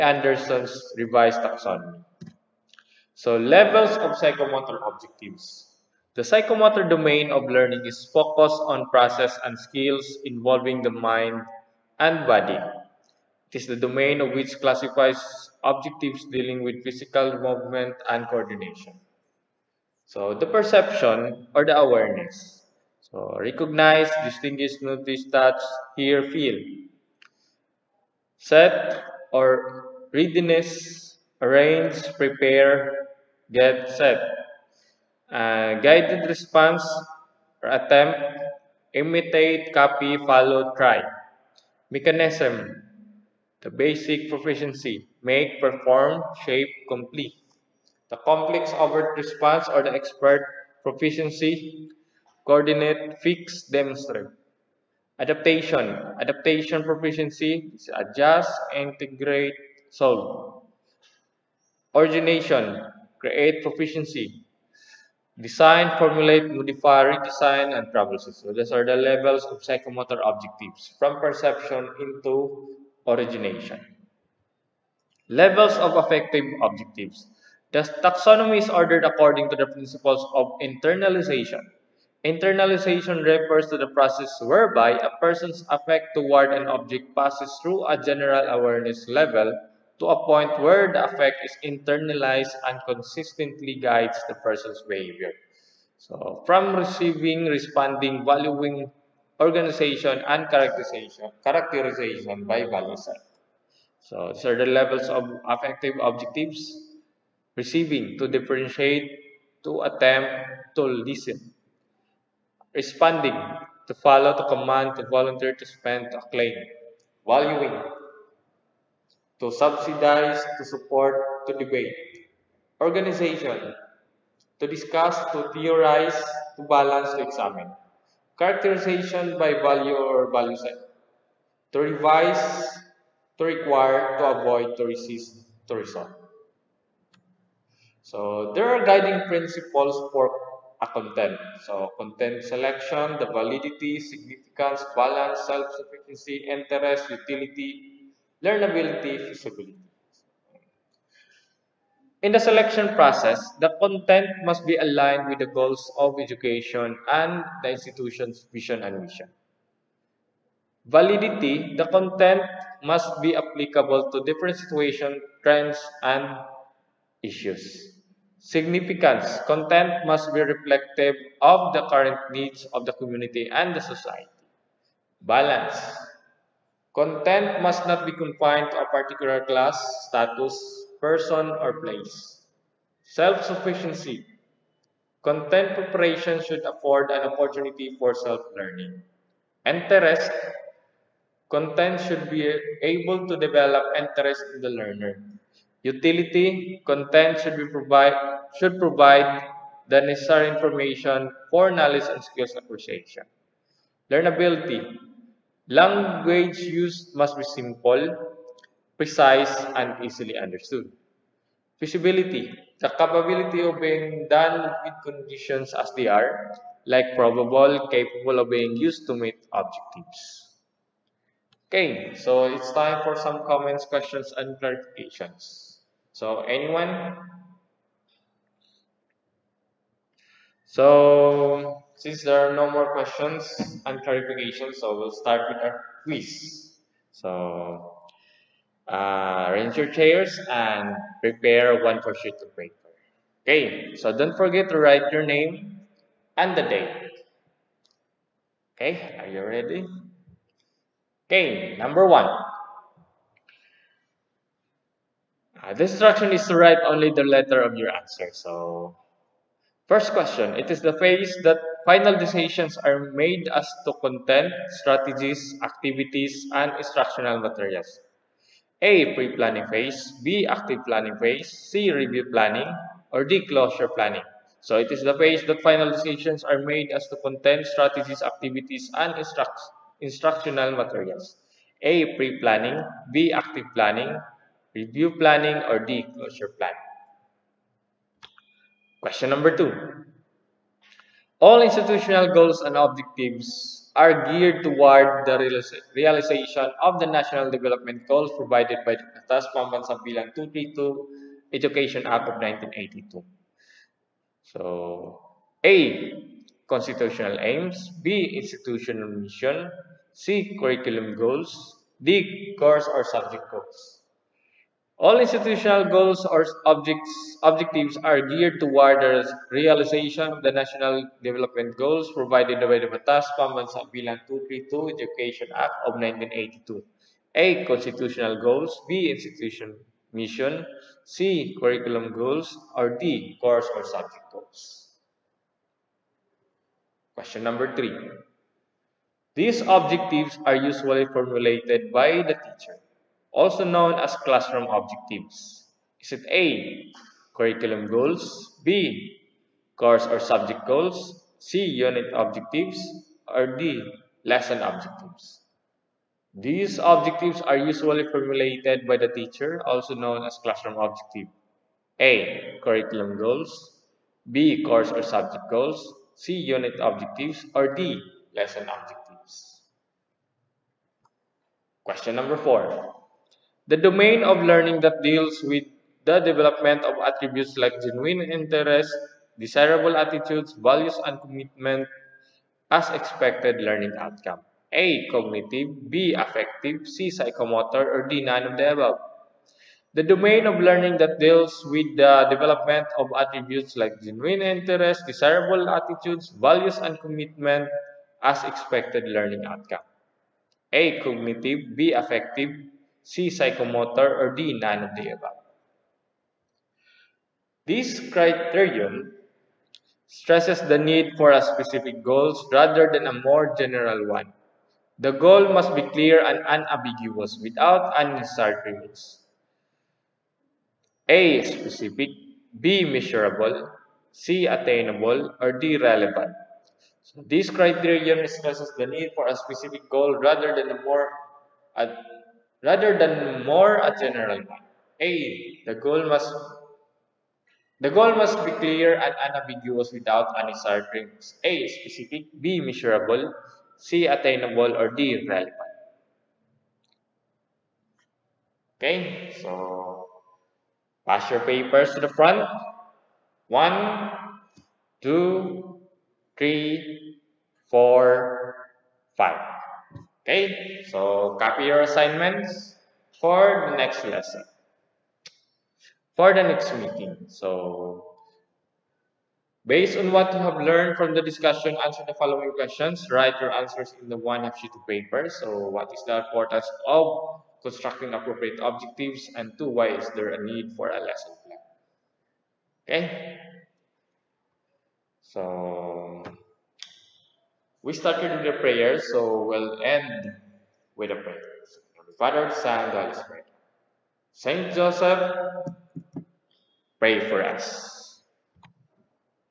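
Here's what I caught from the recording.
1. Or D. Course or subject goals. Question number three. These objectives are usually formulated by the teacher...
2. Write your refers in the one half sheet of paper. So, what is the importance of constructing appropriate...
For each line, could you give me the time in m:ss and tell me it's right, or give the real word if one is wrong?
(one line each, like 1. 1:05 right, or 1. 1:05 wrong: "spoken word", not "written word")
1. 5:32 right
2. 7:53 wrong: "answers", not "refers".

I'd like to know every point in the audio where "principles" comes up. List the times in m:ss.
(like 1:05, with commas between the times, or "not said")
1:19, 2:19.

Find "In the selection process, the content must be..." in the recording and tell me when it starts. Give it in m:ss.
2:32.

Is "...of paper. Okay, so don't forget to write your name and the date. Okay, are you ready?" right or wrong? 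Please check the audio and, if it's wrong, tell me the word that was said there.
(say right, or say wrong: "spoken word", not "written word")
right.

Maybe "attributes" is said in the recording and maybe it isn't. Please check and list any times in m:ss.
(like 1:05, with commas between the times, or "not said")
6:17, 6:33.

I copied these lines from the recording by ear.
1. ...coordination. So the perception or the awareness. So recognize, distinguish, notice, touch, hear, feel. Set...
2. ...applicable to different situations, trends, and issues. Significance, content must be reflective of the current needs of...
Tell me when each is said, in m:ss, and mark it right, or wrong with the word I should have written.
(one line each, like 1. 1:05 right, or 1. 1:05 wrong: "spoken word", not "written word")
1. 0:18 right
2. 2:43 right.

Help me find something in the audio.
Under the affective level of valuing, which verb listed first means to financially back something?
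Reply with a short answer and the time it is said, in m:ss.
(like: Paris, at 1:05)
to subsidize, at 1:59.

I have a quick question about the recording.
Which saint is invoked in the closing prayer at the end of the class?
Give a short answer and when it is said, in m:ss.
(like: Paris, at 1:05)
Saint Joseph, at 8:14.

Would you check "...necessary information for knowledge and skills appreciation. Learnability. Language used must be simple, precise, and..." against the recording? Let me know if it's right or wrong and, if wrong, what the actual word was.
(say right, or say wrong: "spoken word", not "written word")
right.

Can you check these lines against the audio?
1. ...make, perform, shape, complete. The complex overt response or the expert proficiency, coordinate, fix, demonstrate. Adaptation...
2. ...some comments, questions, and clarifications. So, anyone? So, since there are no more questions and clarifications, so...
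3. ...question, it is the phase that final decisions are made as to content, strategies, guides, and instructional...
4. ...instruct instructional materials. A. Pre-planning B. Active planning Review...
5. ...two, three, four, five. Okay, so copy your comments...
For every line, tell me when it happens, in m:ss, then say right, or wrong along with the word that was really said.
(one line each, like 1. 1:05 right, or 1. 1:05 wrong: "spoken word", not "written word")
1. 0:45 right
2. 3:43 right
3. 4:20 wrong: "activities", not "guides"
4. 4:39 right
5. 7:35 wrong: "assignments", not "comments".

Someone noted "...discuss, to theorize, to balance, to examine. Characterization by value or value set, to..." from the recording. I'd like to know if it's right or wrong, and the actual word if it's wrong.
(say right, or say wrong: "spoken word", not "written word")
right.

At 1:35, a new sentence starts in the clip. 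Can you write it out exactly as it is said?
So, from receiving, responding, valuing, organization, and characterization, characterization by value set.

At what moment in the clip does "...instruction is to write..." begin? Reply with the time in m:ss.
4:15.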